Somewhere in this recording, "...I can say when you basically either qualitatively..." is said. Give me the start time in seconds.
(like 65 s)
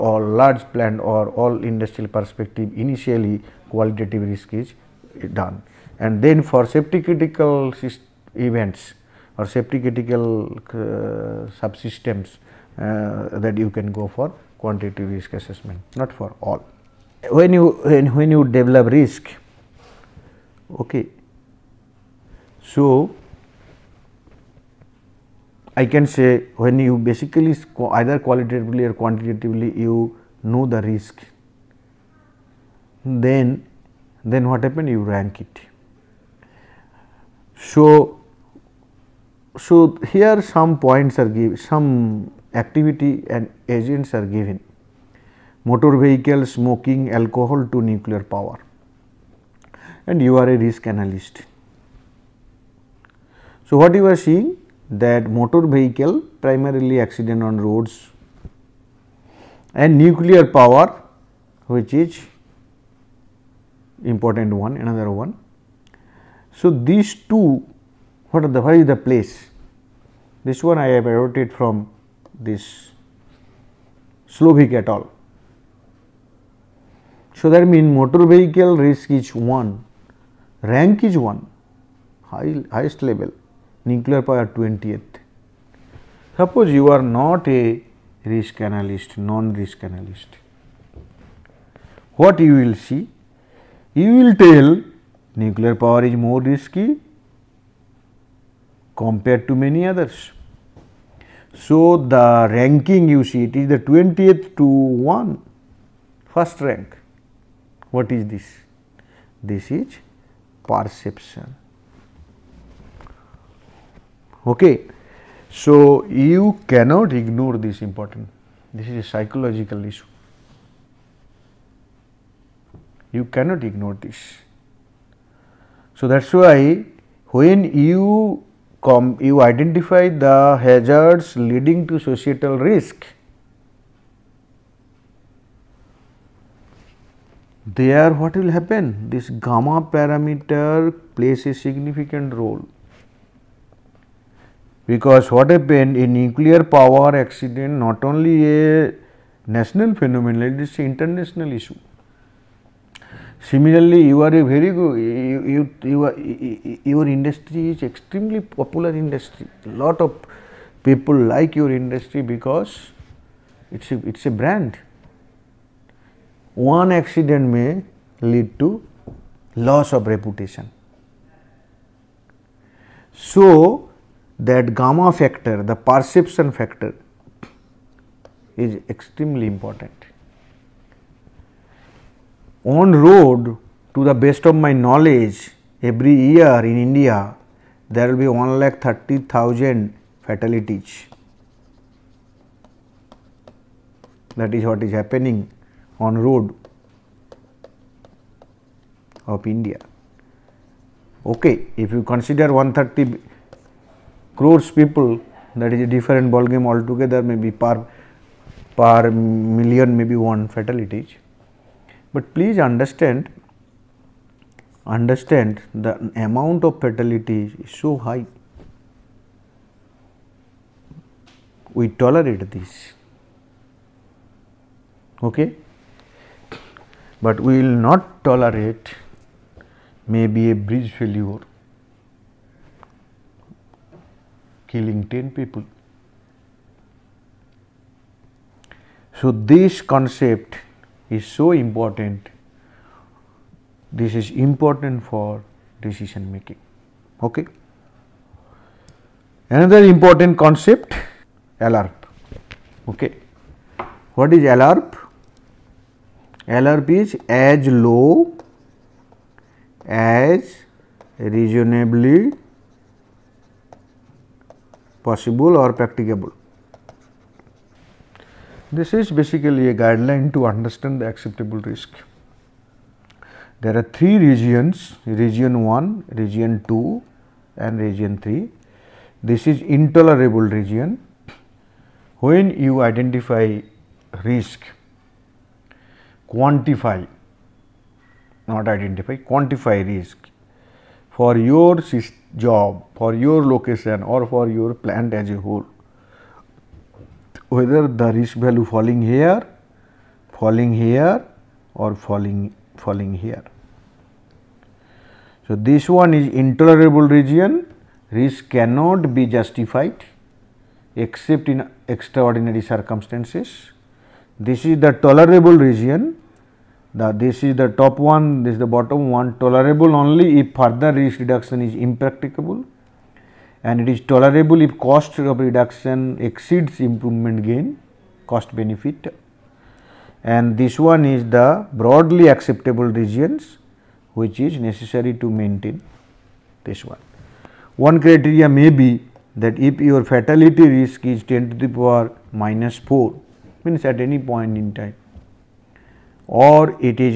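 25 s.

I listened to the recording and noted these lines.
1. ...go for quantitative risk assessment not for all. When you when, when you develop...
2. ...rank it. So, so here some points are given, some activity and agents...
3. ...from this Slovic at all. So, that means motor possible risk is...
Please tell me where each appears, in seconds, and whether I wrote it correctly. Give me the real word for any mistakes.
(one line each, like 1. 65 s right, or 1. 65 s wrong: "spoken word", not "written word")
1. 13 s right
2. 35 s right
3. 71 s wrong: "vehicle", not "possible".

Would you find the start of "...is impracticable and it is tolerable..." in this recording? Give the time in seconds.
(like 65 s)
321 s.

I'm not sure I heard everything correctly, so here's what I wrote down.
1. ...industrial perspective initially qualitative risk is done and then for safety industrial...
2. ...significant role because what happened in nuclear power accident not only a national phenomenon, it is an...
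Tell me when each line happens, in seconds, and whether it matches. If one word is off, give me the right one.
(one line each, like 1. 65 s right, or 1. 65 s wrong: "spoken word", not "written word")
1. 1 s wrong: "critical", not "industrial"
2. 141 s right.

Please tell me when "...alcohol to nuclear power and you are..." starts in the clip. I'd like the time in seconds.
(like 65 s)
47 s.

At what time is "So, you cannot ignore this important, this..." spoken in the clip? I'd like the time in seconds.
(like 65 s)
115 s.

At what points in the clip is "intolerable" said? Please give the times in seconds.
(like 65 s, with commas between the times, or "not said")
279 s, 306 s.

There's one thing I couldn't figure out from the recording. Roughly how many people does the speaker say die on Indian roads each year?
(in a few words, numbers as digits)
130,000.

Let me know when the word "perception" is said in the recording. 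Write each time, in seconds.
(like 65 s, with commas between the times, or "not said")
110 s, 175 s.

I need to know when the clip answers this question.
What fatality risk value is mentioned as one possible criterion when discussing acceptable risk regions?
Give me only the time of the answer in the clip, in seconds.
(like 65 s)
341 s.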